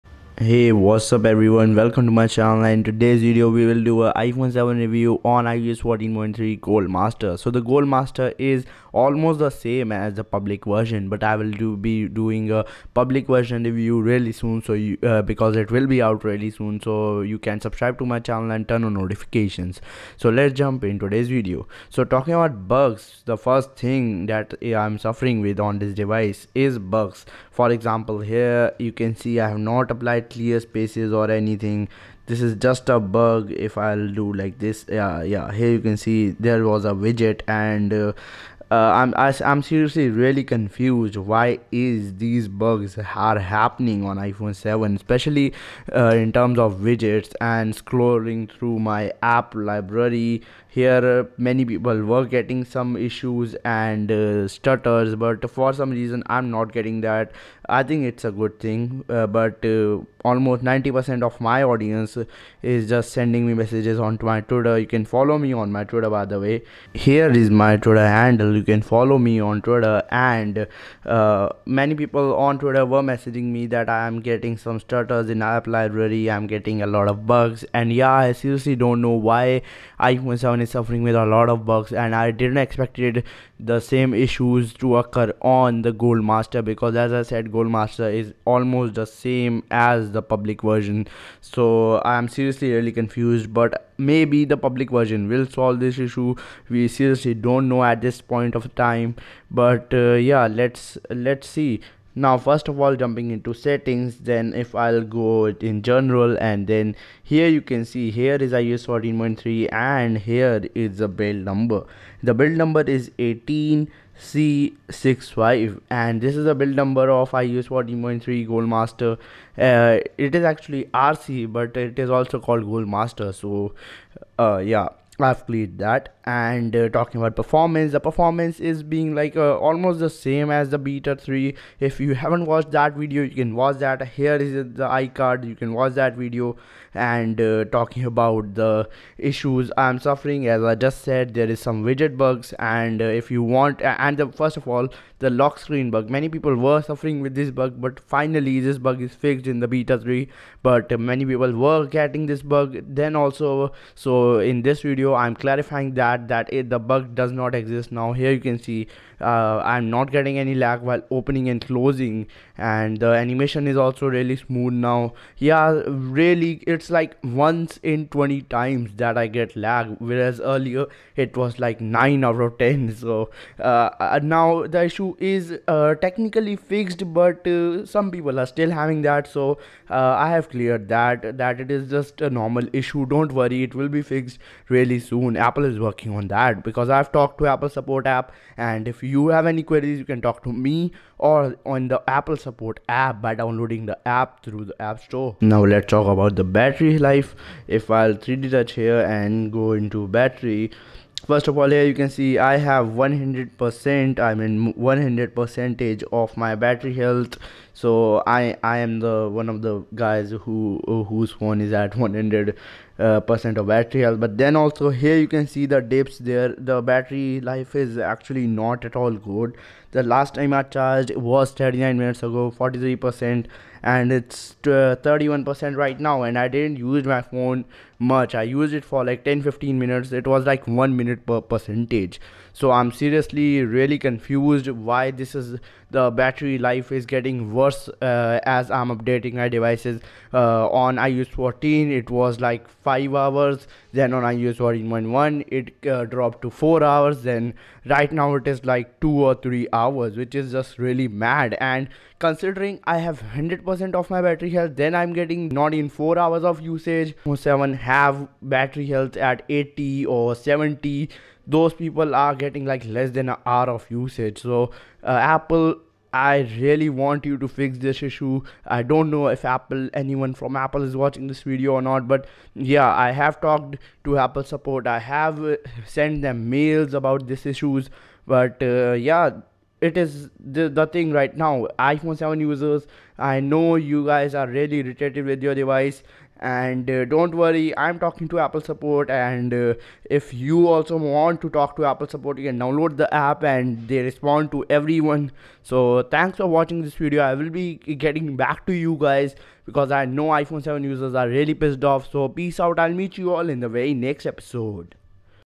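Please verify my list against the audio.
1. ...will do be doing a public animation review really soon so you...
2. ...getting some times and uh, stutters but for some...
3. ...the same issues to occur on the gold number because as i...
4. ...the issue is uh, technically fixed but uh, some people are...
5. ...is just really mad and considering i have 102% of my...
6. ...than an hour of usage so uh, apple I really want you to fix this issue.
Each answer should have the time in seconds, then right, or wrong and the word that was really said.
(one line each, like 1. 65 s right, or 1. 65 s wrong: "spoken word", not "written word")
1. 11 s wrong: "version", not "animation"
2. 52 s wrong: "issues", not "times"
3. 83 s wrong: "master", not "number"
4. 174 s right
5. 250 s wrong: "100", not "102"
6. 263 s right.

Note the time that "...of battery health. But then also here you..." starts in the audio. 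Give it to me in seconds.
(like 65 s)
213 s.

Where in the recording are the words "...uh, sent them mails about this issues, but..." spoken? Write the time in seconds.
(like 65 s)
275 s.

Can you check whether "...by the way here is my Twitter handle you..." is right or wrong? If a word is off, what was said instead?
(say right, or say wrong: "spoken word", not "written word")
right.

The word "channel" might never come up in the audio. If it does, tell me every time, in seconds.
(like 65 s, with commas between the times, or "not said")
2 s, 18 s.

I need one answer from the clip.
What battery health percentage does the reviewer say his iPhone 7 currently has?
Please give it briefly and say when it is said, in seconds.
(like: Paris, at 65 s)
100%, at 204 s.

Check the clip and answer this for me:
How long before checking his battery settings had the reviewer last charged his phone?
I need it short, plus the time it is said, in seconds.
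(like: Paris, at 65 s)
39 minutes, at 221 s.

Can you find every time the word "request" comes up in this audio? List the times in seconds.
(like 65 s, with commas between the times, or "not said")
not said.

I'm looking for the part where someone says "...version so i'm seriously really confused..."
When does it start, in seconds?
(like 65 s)
90 s.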